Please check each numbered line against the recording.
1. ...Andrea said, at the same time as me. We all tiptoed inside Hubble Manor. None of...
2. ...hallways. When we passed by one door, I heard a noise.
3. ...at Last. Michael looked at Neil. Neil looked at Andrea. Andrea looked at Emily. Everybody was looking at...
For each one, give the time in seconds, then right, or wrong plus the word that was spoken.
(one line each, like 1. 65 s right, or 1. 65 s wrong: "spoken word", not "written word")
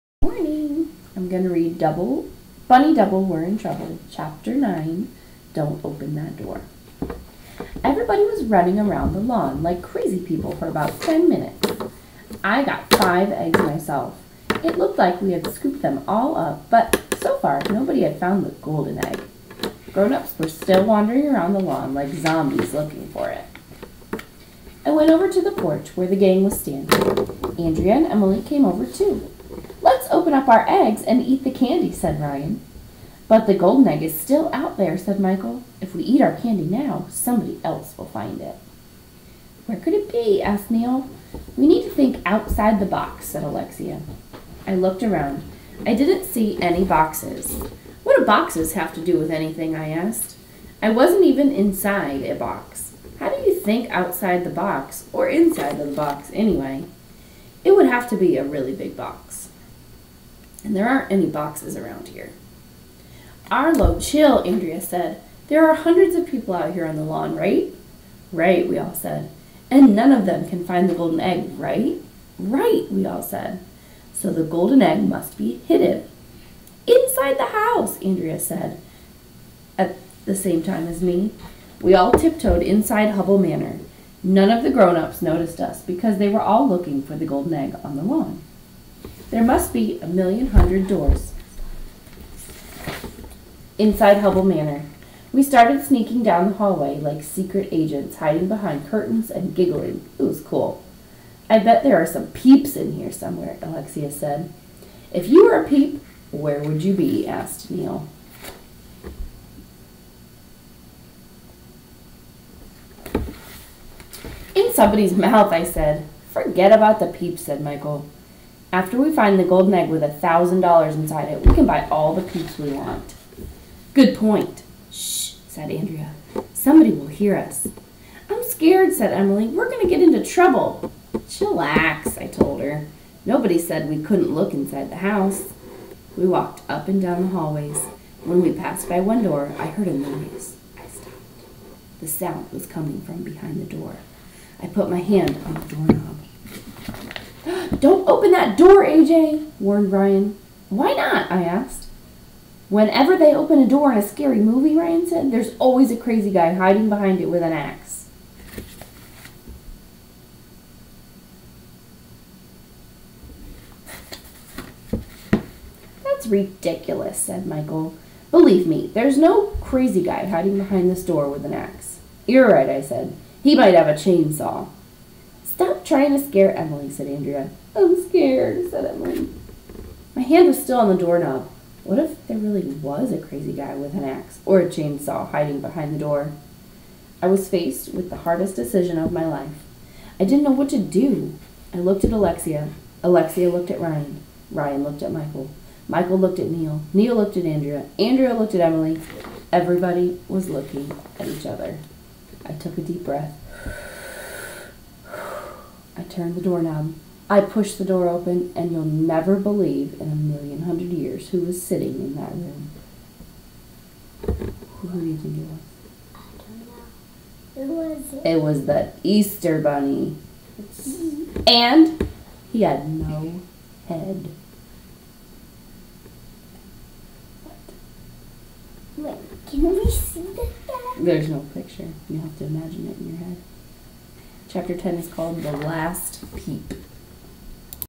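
1. 78 s right
2. 137 s right
3. 195 s wrong: "Michael", not "Last".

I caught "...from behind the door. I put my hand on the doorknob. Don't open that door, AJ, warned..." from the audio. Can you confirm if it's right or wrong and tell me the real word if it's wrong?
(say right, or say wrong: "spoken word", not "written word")
right.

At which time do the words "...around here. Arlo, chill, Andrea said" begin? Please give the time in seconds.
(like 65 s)
61 s.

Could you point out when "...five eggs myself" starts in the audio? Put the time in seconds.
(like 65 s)
12 s.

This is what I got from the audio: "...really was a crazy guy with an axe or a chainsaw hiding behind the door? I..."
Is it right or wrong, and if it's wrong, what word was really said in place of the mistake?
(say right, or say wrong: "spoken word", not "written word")
right.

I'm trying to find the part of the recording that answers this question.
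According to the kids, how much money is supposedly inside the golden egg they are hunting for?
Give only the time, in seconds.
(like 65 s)
120 s.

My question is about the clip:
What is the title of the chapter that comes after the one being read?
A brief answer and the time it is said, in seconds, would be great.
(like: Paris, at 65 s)
The Last Peep, at 235 s.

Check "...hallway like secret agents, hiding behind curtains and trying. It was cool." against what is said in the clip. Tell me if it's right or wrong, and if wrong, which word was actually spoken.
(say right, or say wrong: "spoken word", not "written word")
wrong: "giggling", not "trying".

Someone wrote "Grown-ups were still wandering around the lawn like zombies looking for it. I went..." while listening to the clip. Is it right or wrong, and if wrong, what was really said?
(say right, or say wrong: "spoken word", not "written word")
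right.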